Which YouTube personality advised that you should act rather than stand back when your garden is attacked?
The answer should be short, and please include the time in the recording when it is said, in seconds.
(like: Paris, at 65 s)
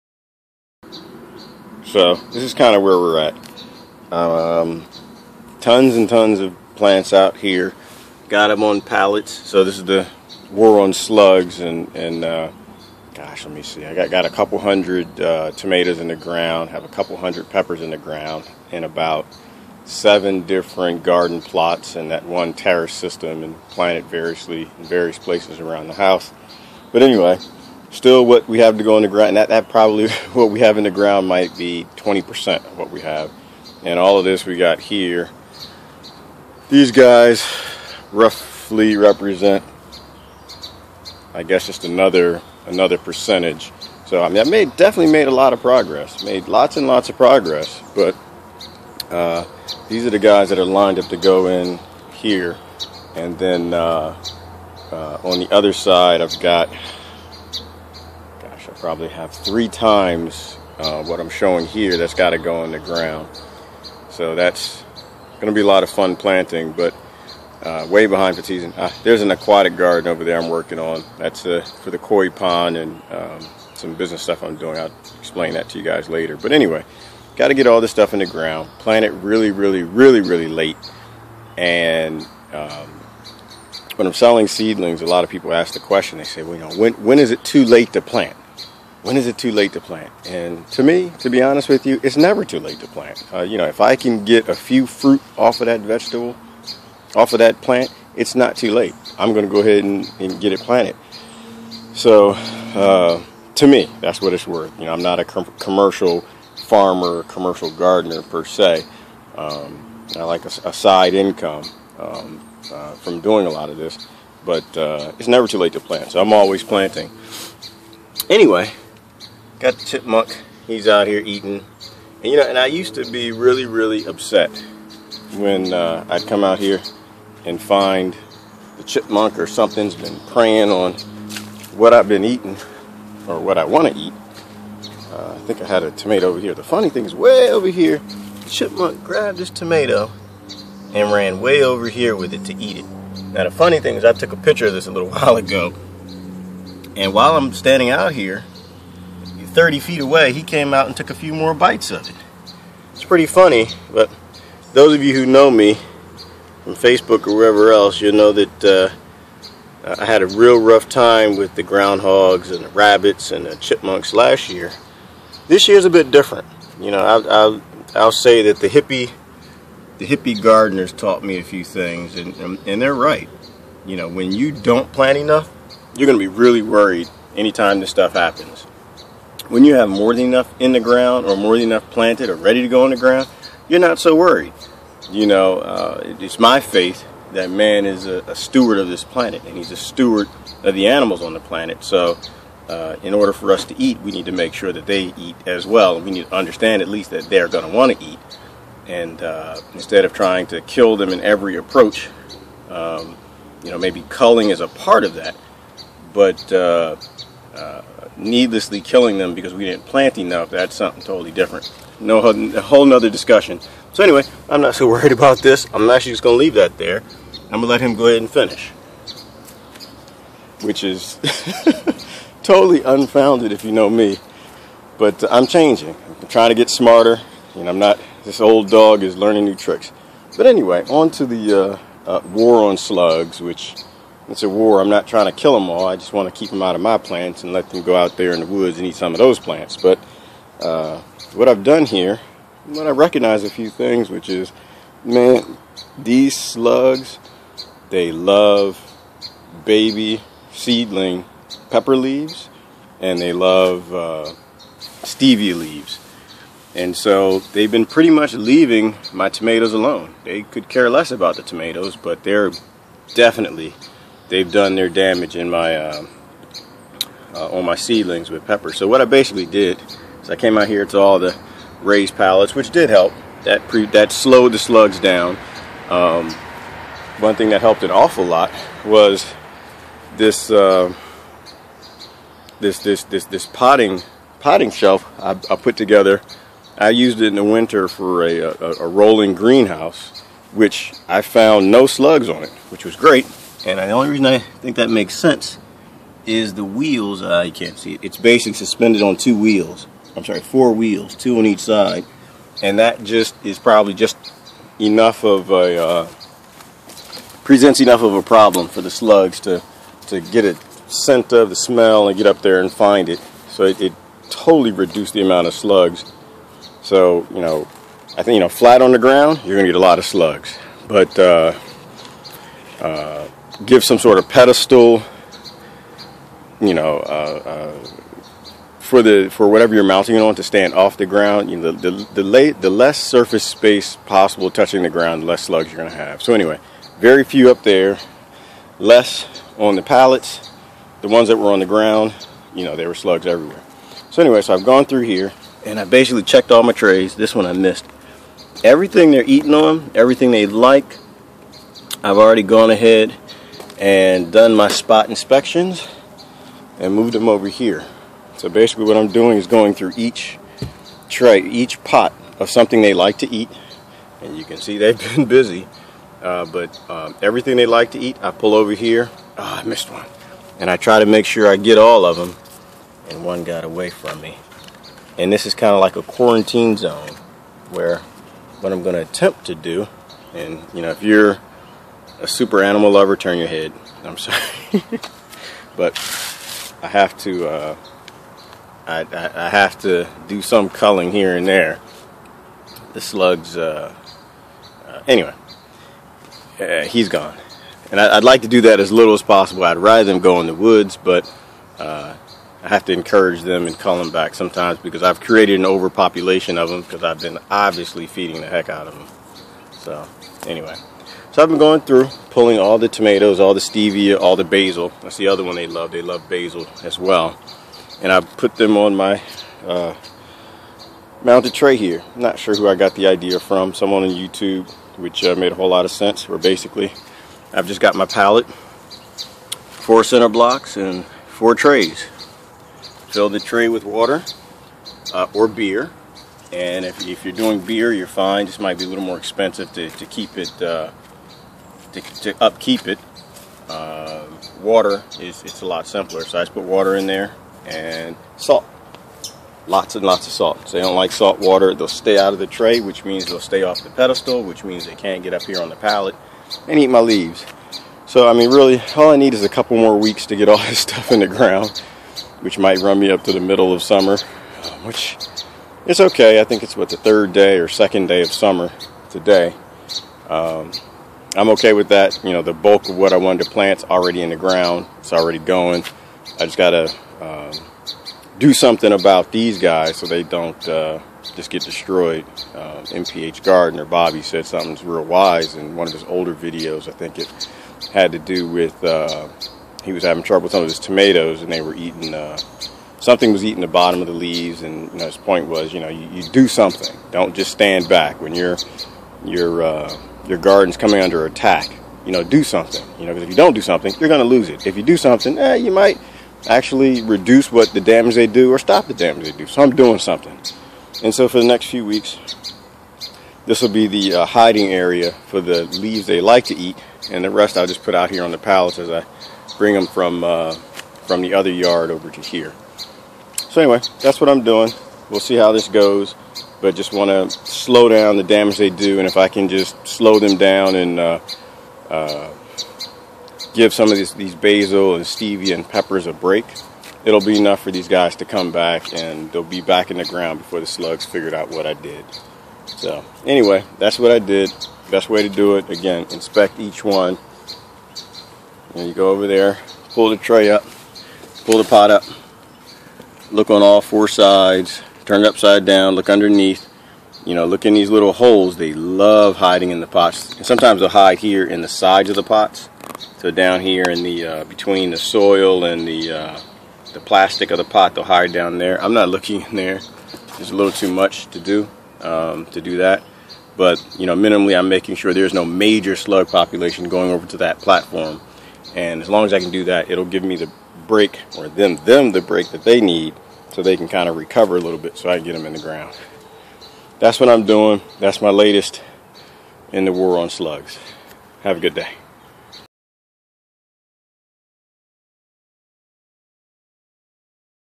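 Gardener Bobby, at 483 s.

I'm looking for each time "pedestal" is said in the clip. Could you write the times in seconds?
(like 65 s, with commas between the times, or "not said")
324 s, 453 s.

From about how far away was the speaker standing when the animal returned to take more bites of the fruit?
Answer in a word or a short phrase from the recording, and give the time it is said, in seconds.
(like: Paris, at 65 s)
30 feet, at 149 s.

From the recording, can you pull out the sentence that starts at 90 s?
And to me, to be honest with you, it's never too late to plant.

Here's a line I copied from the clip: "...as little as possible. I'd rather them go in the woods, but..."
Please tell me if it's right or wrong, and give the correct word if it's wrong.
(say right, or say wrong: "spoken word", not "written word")
right.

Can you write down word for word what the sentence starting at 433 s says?
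Fill the tray with water uh, or beer.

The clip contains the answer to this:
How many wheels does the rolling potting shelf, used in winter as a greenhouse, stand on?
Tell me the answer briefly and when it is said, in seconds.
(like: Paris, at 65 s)
4, at 300 s.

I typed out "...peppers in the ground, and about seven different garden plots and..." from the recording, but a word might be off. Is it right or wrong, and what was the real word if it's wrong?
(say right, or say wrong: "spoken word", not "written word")
right.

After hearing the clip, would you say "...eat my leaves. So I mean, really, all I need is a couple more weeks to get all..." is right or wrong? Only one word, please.
right.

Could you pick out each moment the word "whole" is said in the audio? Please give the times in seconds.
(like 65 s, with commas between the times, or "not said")
212 s, 425 s.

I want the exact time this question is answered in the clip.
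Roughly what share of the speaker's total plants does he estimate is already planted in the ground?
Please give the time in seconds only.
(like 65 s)
31 s.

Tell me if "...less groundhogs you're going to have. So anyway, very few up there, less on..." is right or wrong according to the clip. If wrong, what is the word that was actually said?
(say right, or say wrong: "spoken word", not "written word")
wrong: "slugs", not "groundhogs".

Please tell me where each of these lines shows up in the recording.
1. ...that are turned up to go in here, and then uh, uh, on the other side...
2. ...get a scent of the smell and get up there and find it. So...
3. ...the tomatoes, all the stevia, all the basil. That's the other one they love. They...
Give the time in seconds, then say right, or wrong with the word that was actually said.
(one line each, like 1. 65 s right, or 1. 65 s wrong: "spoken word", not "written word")
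1. 50 s wrong: "lined", not "turned"
2. 310 s right
3. 412 s right.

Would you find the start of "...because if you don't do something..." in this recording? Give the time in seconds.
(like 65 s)
503 s.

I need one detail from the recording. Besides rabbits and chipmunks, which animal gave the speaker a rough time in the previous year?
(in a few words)
Groundhogs.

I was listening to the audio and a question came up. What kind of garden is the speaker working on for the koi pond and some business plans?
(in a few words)
Aquatic garden.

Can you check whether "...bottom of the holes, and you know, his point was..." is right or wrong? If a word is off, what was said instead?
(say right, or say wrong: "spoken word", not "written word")
wrong: "leaves", not "holes".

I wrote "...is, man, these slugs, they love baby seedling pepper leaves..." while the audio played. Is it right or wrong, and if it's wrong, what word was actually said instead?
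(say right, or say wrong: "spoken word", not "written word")
right.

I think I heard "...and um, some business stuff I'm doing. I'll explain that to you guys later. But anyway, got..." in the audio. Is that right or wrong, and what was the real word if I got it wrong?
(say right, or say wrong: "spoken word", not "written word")
right.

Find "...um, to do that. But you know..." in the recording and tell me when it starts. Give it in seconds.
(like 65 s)
572 s.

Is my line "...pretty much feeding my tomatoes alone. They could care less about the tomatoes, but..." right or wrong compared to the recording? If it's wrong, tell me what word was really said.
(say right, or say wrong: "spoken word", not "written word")
wrong: "leaving", not "feeding".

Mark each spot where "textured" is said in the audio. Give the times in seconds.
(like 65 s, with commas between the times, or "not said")
not said.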